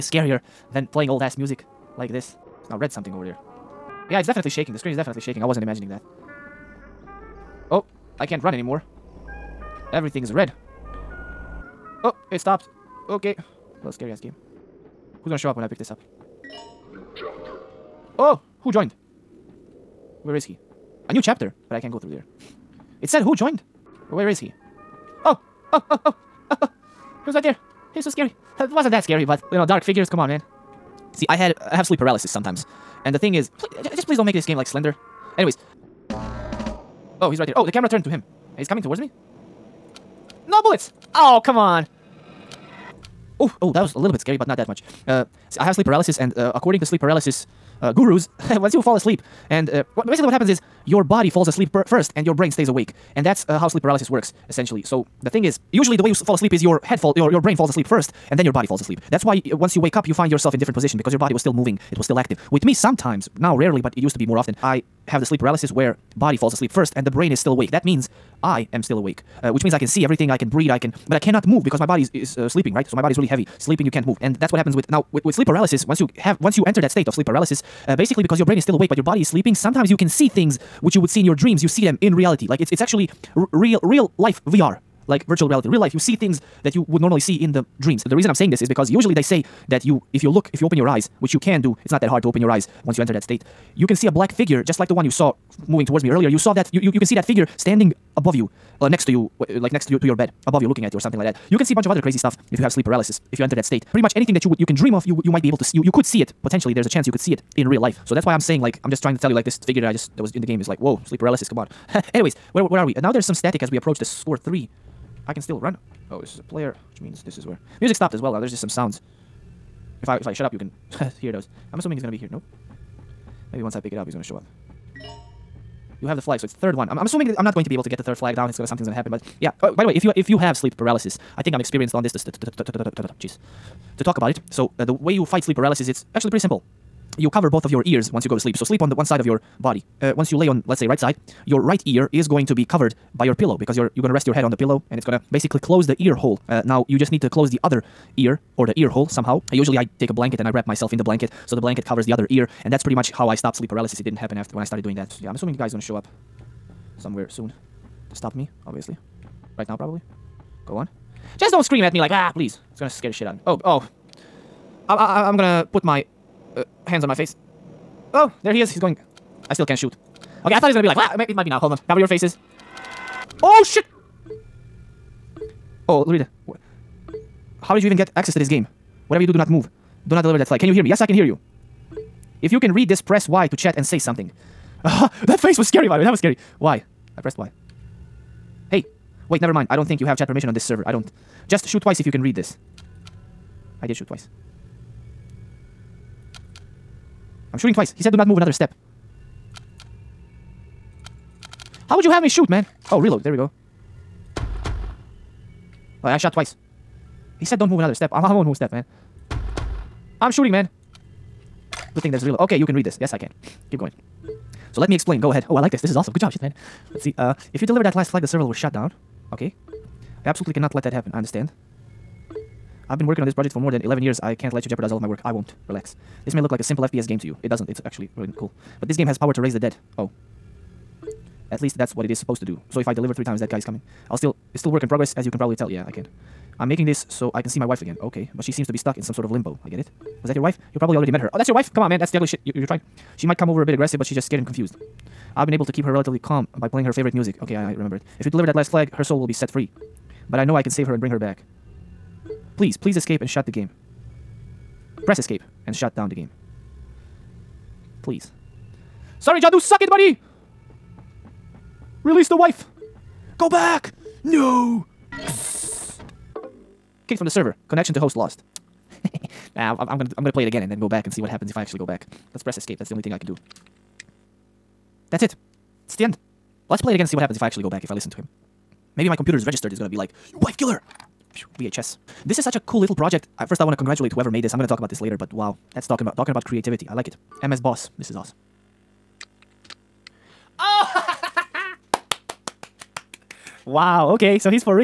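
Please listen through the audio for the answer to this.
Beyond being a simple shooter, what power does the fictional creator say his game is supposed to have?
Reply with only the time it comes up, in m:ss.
3:49.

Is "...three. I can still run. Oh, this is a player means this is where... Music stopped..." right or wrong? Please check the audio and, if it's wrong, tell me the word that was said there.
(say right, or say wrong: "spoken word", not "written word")
right.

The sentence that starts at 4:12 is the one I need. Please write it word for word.
Please, please escape and shut the game.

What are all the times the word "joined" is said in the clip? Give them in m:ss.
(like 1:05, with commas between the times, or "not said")
0:18, 0:23.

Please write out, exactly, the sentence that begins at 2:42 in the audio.
It's gonna scare the shit out of me.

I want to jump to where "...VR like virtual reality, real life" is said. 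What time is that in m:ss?
1:24.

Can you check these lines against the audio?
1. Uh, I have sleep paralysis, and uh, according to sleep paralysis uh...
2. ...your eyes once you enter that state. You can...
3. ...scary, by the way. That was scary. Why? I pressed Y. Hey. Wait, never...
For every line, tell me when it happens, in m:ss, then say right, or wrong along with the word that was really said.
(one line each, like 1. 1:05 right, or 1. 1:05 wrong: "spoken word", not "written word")
1. 0:45 right
2. 1:32 right
3. 3:05 right.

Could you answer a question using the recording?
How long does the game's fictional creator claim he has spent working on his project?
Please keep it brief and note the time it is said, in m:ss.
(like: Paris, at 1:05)
More than 11 years, at 3:43.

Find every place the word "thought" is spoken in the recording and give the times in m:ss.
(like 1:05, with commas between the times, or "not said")
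2:50.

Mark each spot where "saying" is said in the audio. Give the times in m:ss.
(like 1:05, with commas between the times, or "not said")
1:28, 1:48.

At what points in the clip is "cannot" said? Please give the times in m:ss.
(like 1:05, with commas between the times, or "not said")
1:11, 3:40.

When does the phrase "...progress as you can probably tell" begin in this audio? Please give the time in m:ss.
3:54.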